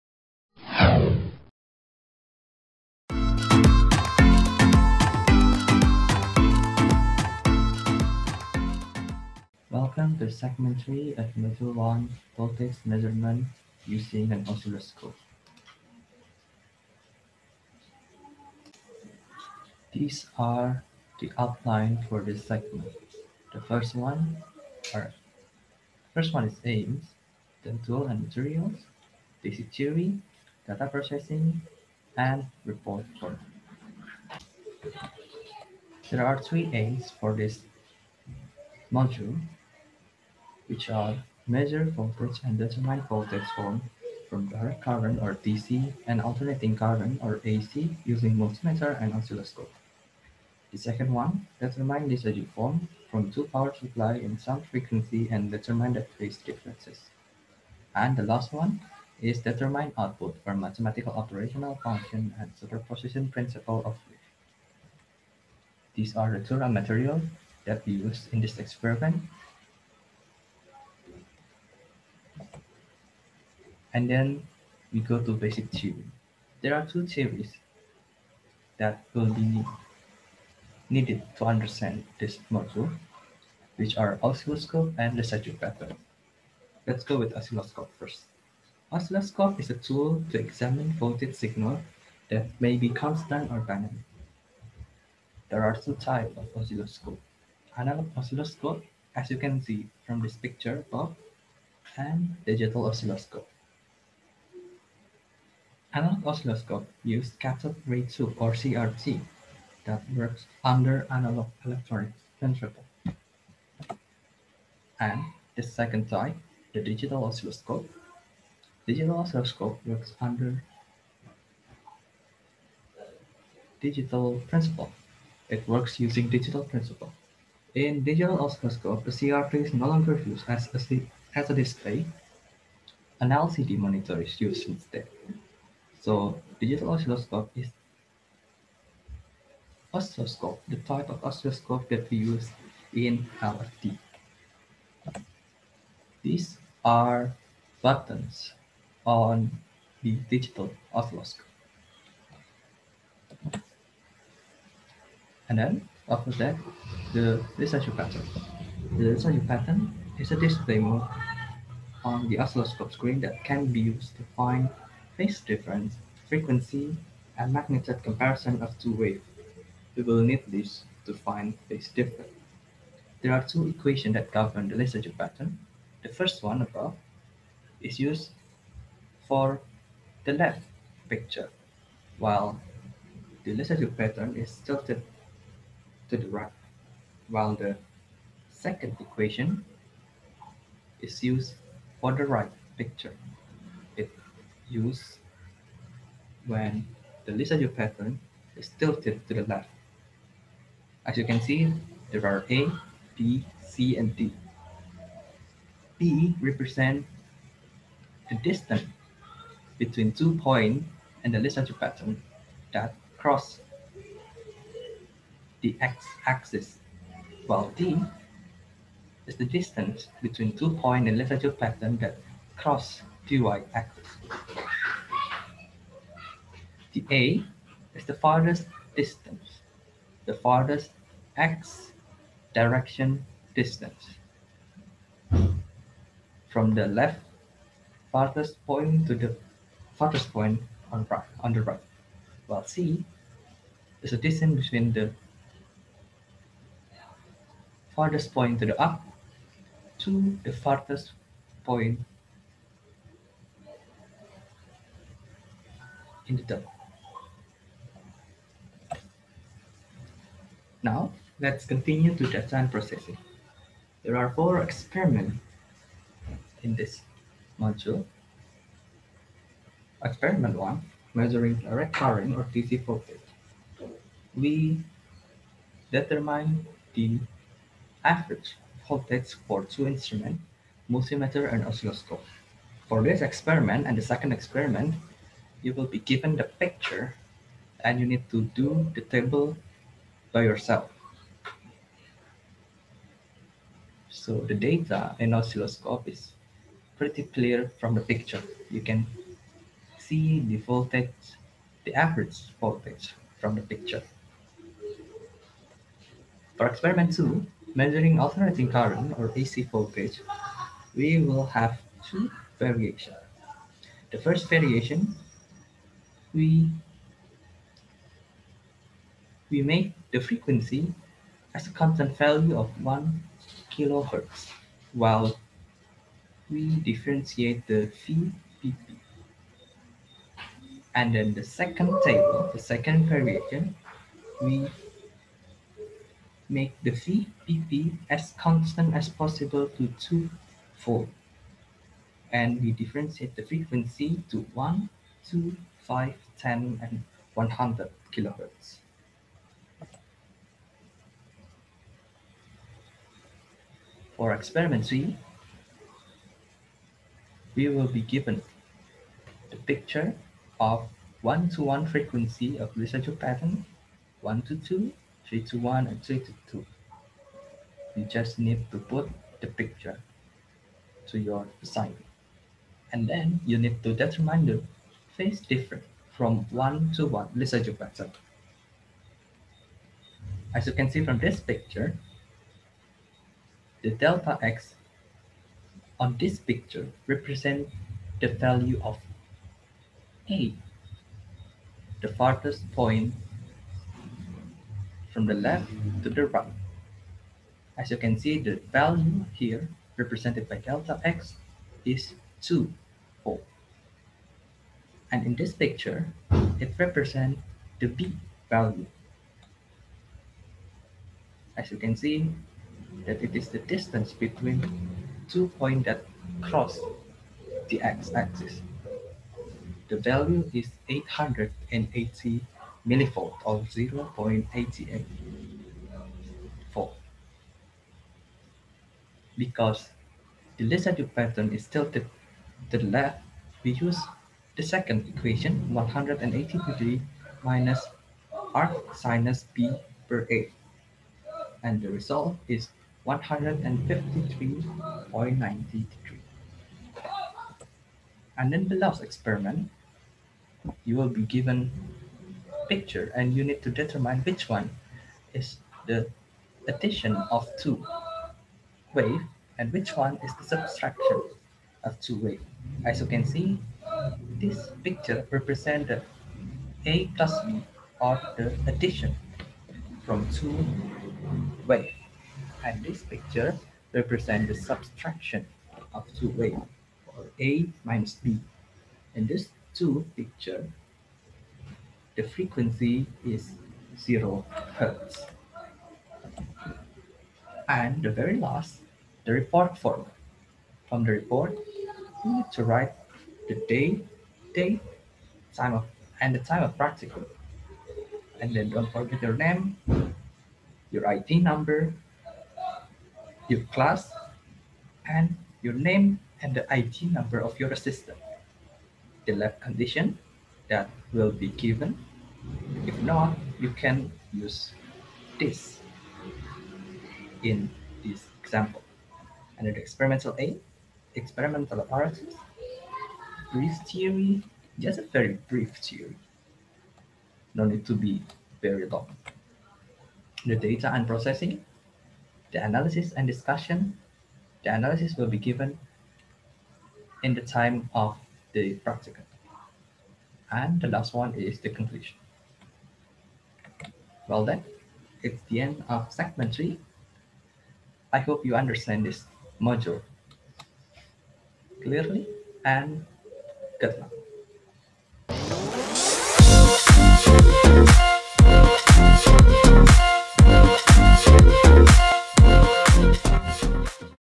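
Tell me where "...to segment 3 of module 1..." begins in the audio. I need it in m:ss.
0:10.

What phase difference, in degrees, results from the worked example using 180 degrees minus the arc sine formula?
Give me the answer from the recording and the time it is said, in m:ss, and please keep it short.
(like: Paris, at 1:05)
153.93 degrees, at 7:23.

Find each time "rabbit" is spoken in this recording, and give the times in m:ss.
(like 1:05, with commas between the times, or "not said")
not said.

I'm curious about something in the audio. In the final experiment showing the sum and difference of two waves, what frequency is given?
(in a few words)
0 hertz.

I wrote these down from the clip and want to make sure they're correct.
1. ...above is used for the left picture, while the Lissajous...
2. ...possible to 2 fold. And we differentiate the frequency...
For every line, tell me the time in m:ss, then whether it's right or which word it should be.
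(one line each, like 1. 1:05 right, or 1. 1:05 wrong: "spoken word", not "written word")
1. 2:56 right
2. 5:39 right.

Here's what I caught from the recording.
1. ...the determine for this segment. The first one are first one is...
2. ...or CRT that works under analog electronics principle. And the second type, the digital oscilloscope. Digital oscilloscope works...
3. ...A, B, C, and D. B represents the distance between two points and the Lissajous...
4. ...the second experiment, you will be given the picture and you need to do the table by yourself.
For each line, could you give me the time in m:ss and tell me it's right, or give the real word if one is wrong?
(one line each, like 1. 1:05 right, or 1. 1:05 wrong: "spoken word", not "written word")
1. 0:21 wrong: "outline", not "determine"
2. 1:48 right
3. 3:22 right
4. 4:43 right.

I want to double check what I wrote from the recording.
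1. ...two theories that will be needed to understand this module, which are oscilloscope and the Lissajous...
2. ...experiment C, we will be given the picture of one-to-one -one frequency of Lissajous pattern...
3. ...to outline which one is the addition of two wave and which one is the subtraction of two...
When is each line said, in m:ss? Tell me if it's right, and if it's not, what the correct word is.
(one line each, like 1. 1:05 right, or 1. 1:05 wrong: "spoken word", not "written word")
1. 1:16 right
2. 5:54 right
3. 7:33 wrong: "determine", not "outline".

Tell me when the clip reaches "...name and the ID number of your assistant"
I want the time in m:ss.
8:25.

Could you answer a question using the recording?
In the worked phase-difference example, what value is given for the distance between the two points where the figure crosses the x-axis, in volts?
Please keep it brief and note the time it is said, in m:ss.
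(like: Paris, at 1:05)
0.88 volt, at 7:03.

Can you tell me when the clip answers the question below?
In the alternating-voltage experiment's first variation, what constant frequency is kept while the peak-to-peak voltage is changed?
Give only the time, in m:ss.
5:22.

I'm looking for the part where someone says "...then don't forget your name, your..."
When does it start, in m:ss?
8:18.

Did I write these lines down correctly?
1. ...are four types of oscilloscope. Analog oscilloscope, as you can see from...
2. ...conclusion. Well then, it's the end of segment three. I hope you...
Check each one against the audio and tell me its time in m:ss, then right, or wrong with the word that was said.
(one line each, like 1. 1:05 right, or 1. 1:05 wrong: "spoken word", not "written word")
1. 1:35 wrong: "two", not "four"
2. 9:01 right.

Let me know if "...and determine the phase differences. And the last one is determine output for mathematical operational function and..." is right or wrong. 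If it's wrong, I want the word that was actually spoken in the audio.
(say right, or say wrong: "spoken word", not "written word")
right.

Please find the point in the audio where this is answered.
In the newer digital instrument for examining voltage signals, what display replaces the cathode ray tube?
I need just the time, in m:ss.
2:13.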